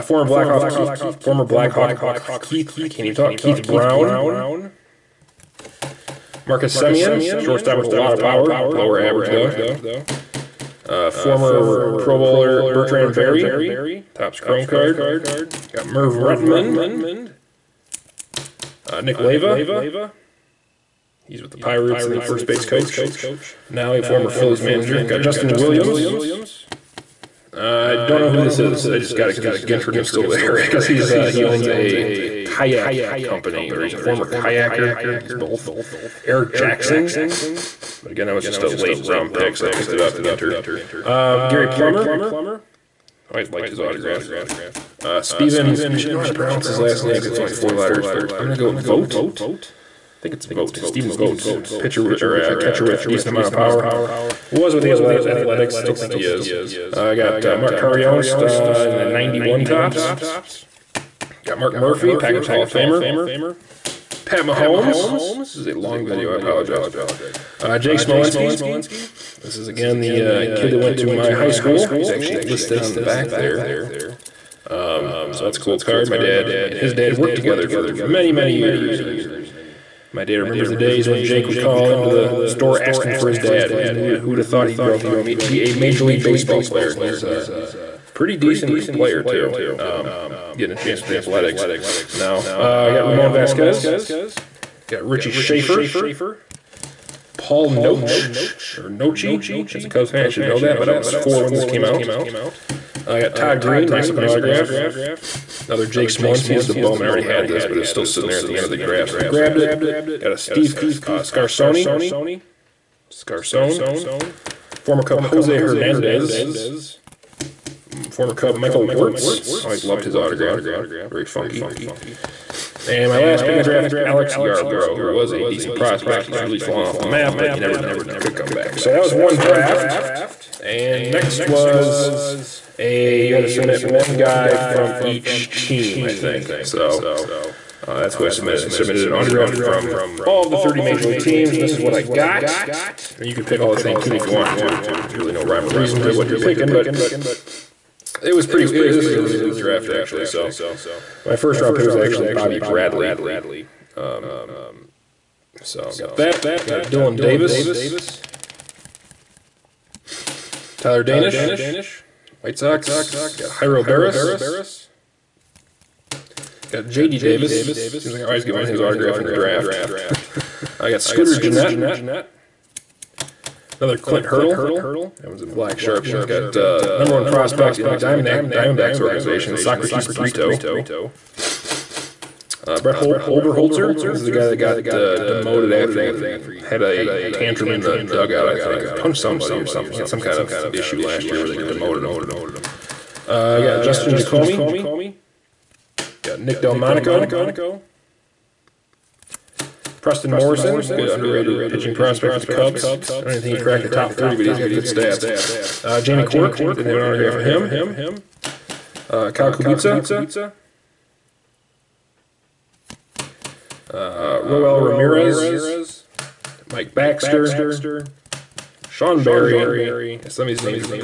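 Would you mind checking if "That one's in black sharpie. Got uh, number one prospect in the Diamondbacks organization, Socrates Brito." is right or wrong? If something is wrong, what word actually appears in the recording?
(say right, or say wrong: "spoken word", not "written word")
right.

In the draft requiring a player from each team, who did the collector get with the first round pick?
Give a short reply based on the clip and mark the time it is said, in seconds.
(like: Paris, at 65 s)
Bobby Bradley, at 152 s.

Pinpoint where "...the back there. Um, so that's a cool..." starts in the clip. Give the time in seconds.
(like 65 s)
72 s.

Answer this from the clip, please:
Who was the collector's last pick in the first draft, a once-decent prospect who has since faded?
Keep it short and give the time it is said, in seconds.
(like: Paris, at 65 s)
Alex Yarbrough, at 124 s.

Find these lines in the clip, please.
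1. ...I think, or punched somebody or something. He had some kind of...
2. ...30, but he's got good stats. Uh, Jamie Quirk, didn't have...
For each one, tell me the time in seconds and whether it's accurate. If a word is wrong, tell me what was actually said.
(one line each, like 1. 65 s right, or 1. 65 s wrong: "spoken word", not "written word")
1. 188 s right
2. 204 s right.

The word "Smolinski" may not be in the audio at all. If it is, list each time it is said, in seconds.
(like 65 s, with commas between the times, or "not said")
67 s, 106 s.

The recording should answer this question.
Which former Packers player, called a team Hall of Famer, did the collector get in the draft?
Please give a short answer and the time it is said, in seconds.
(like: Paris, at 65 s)
Mark Murphy, at 61 s.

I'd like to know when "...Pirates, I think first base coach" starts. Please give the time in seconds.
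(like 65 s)
21 s.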